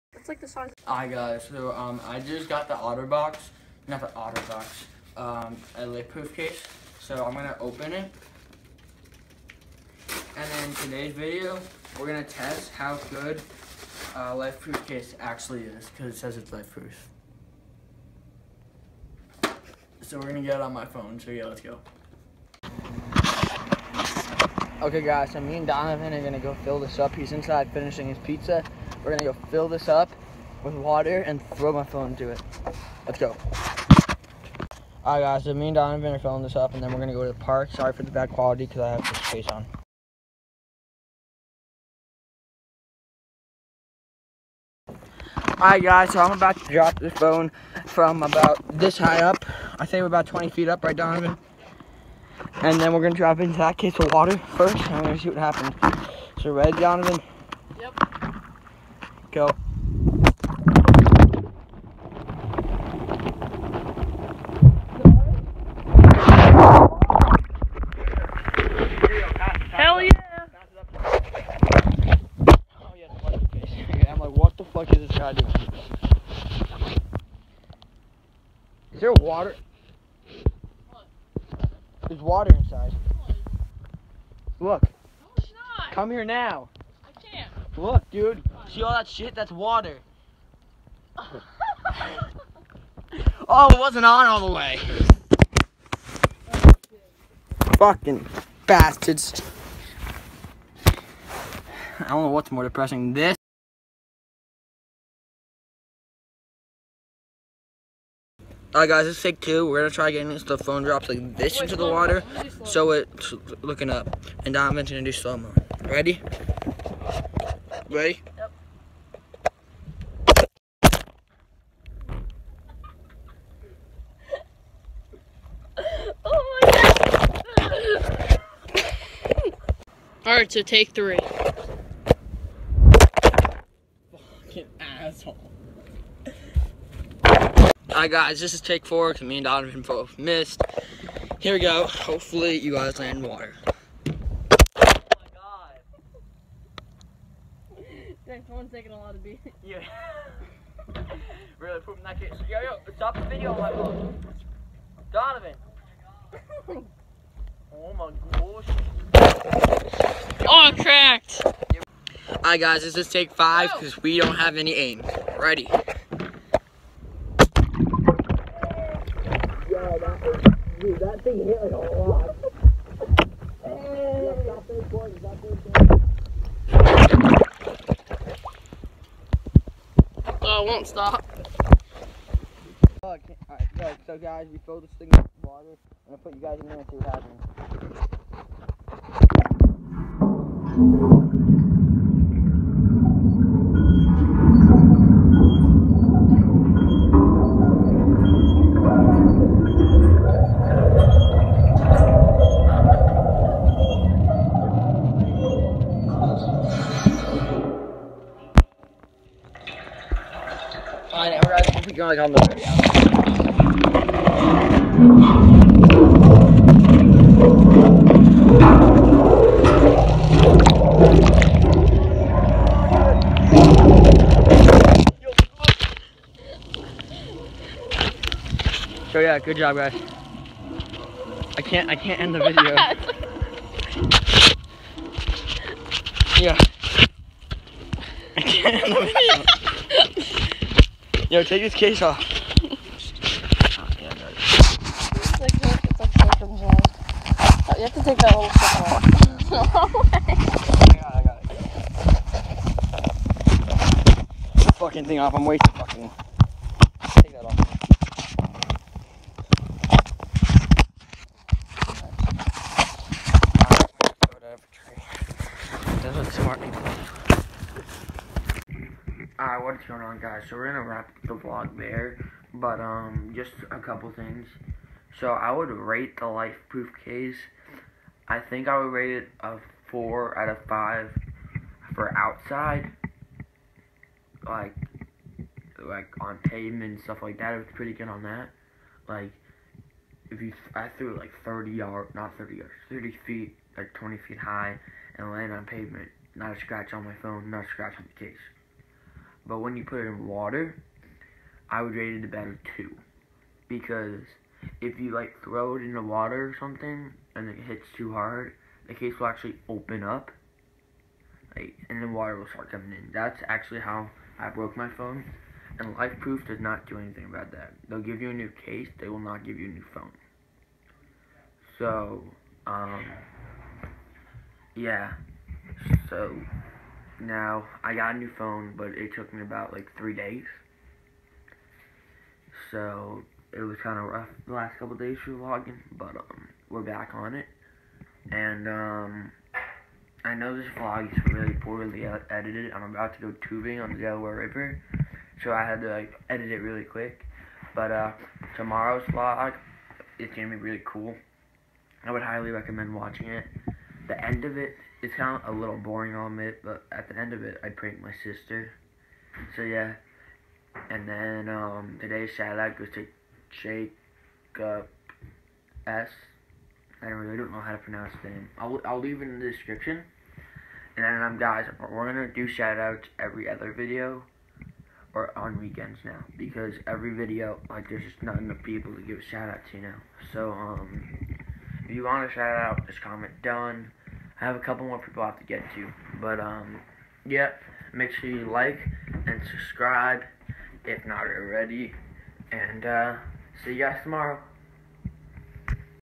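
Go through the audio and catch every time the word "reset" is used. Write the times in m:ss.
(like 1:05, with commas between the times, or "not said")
not said.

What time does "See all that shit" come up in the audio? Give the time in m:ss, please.
1:28.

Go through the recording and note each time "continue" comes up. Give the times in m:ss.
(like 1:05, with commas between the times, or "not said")
not said.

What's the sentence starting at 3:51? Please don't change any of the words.
I can't I can't end the video.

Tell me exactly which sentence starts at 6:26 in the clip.
But, um, yeah, make sure you like and subscribe if not already.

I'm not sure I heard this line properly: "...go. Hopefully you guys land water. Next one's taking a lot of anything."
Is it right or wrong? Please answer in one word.
wrong.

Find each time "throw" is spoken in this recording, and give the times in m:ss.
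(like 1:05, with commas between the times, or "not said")
0:31, 5:05.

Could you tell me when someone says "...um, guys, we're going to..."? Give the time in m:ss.
6:11.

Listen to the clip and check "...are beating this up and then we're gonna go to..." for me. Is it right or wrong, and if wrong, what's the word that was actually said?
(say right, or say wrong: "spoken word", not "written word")
wrong: "filling", not "beating".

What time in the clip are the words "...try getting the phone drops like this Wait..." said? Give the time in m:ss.
1:49.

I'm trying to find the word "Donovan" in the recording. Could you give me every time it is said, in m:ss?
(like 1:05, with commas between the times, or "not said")
0:25, 0:35, 0:50, 0:56, 2:19, 2:35.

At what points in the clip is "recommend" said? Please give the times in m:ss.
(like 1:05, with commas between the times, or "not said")
5:52.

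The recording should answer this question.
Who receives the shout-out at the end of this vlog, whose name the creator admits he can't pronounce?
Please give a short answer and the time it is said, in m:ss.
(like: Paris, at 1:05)
Jacob S., at 6:03.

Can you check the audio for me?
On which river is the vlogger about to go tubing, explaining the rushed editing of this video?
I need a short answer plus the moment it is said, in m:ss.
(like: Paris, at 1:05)
Delaware River, at 5:43.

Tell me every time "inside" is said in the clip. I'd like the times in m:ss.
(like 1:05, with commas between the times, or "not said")
0:27, 1:22.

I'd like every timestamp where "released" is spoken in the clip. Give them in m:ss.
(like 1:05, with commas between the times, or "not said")
not said.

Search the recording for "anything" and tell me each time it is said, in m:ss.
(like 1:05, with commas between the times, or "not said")
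5:16.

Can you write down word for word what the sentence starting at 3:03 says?
Alright, so guys, we this thing water.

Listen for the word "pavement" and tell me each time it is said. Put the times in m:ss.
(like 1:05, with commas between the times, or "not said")
4:46, 4:55.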